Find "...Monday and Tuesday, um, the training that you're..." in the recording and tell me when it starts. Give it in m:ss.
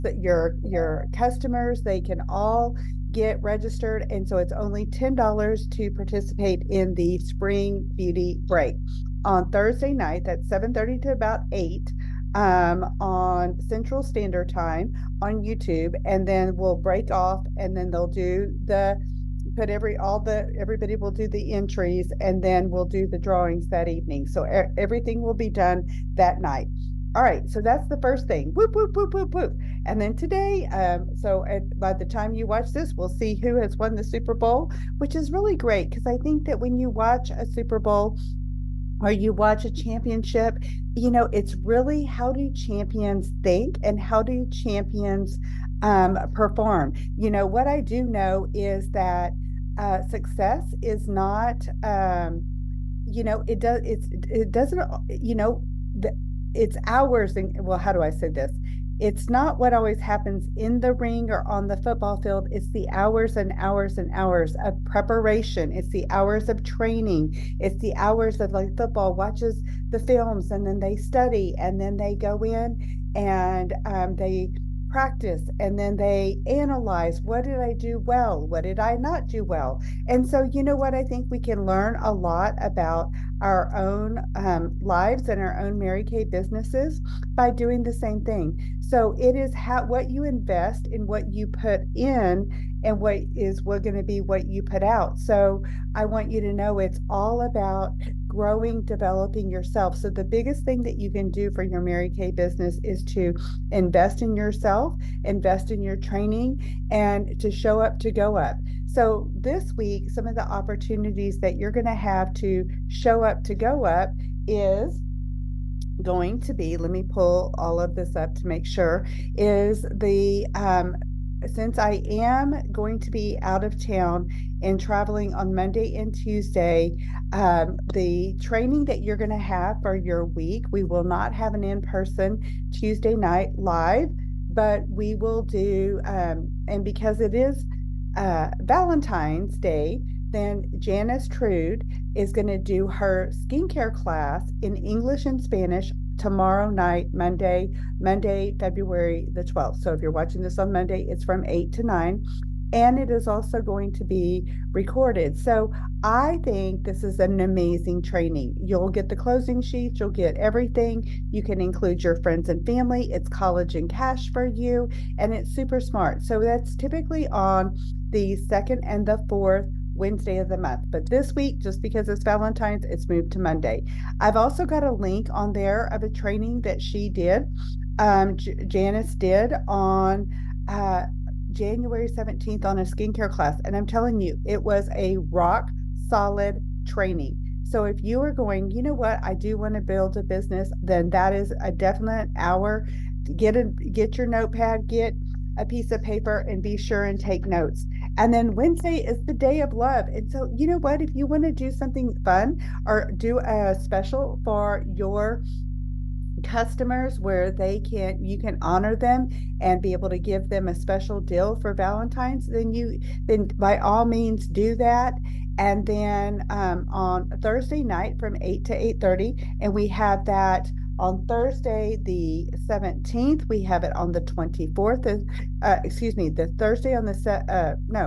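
2:05.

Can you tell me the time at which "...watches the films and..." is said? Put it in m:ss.
1:09.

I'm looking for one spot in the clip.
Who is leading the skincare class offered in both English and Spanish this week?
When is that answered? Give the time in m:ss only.
2:20.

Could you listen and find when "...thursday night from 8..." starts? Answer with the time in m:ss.
3:37.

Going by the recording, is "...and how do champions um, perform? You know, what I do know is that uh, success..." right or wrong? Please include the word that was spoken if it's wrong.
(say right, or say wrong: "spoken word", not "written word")
right.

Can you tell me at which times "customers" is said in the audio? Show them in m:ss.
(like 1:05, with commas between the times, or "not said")
0:01, 3:26.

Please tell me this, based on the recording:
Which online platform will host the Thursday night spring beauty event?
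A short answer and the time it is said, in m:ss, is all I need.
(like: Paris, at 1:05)
YouTube, at 0:15.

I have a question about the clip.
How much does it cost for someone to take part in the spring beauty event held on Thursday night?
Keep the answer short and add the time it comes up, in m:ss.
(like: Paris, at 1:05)
$10, at 0:04.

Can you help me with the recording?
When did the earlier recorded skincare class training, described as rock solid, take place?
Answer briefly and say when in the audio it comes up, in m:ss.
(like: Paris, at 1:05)
January 17th, at 3:01.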